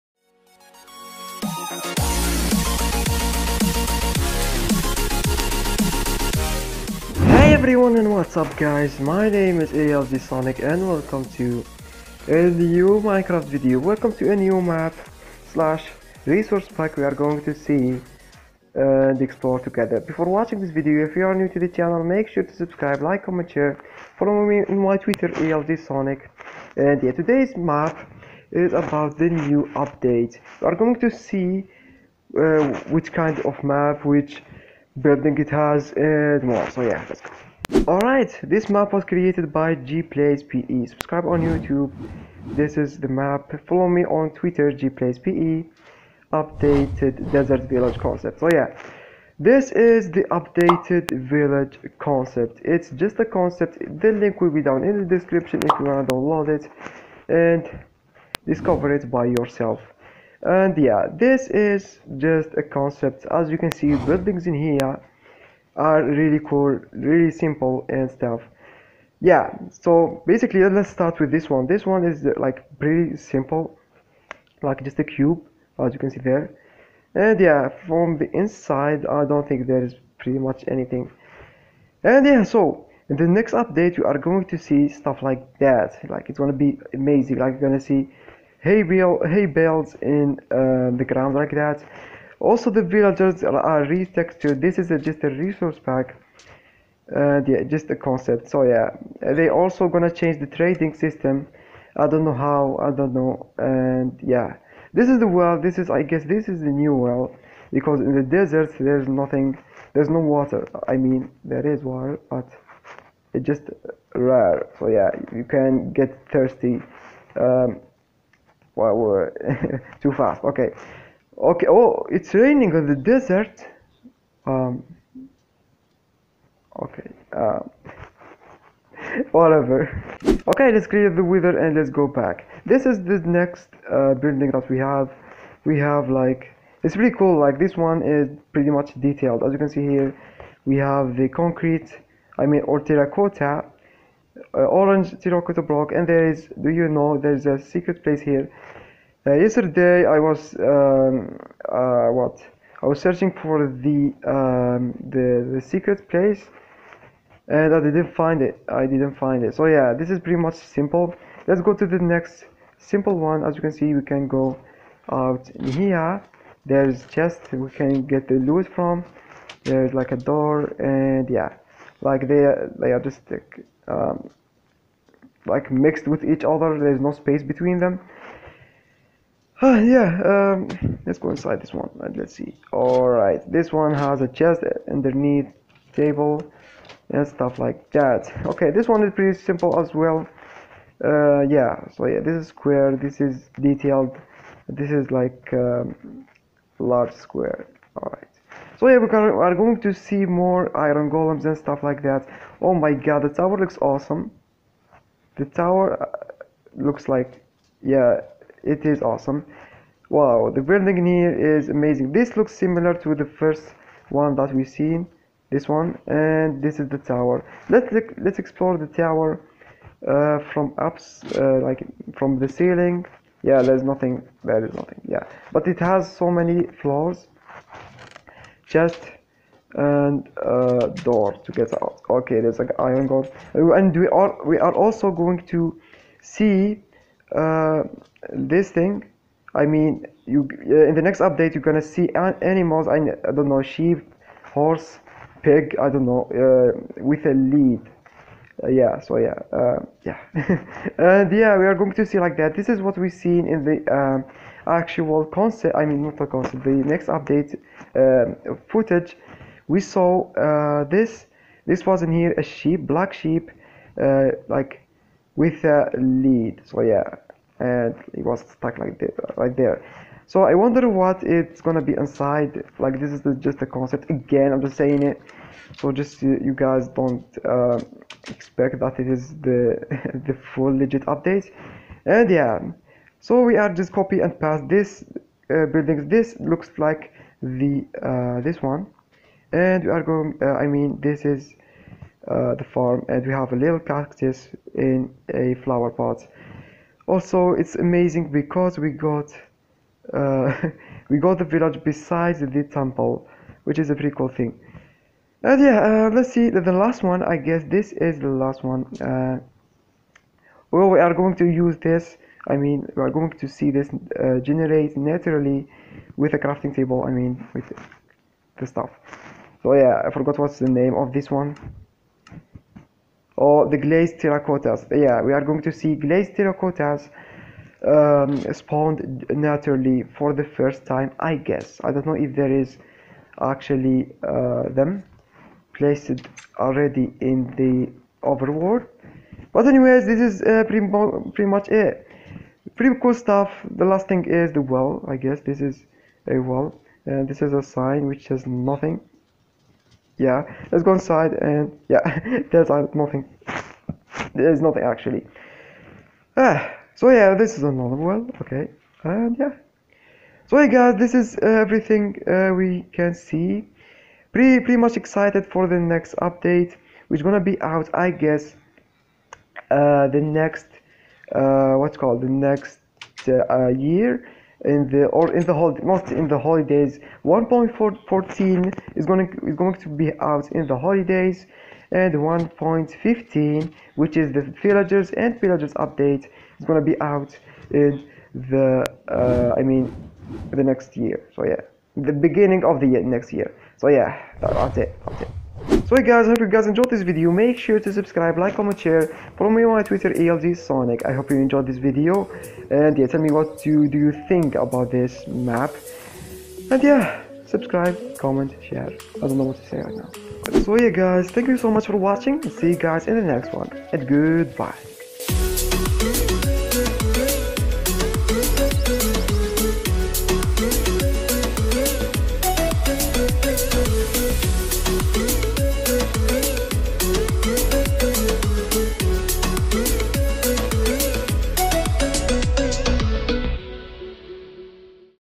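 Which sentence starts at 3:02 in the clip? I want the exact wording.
Alright, this one has a chest underneath table and stuff like that.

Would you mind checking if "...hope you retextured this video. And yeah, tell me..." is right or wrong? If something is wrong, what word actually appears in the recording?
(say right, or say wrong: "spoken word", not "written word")
wrong: "enjoyed", not "retextured".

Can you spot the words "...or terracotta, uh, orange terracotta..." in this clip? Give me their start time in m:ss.
2:22.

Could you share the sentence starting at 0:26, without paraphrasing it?
And yeah, today's map is about the new update.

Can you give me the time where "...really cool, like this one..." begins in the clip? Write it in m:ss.
2:16.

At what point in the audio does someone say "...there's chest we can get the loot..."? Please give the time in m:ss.
2:46.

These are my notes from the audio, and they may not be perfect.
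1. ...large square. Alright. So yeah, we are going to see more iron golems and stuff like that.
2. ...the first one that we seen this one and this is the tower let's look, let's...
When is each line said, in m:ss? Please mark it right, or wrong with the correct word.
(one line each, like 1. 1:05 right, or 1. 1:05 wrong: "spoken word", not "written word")
1. 3:16 right
2. 3:33 right.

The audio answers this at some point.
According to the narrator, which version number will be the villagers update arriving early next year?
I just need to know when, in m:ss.
6:22.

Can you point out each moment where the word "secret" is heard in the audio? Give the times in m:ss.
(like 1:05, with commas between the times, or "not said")
2:27, 2:35.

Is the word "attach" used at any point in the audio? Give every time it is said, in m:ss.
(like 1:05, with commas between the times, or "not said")
not said.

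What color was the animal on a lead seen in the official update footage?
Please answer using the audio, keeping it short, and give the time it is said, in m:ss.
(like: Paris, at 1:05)
Black, at 4:22.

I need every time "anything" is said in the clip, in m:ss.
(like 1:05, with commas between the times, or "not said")
1:20.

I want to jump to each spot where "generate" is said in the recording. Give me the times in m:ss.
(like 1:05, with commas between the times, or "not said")
5:14.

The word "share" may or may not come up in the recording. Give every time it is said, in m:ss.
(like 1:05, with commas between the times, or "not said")
0:23, 6:38, 6:48.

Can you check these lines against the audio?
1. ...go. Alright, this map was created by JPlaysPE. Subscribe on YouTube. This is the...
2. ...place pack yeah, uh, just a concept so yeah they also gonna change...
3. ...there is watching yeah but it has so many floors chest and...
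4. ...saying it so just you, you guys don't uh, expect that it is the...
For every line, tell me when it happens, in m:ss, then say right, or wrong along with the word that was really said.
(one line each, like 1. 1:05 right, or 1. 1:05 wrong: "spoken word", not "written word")
1. 0:37 right
2. 1:35 wrong: "resource", not "place"
3. 3:44 wrong: "nothing", not "watching"
4. 4:34 right.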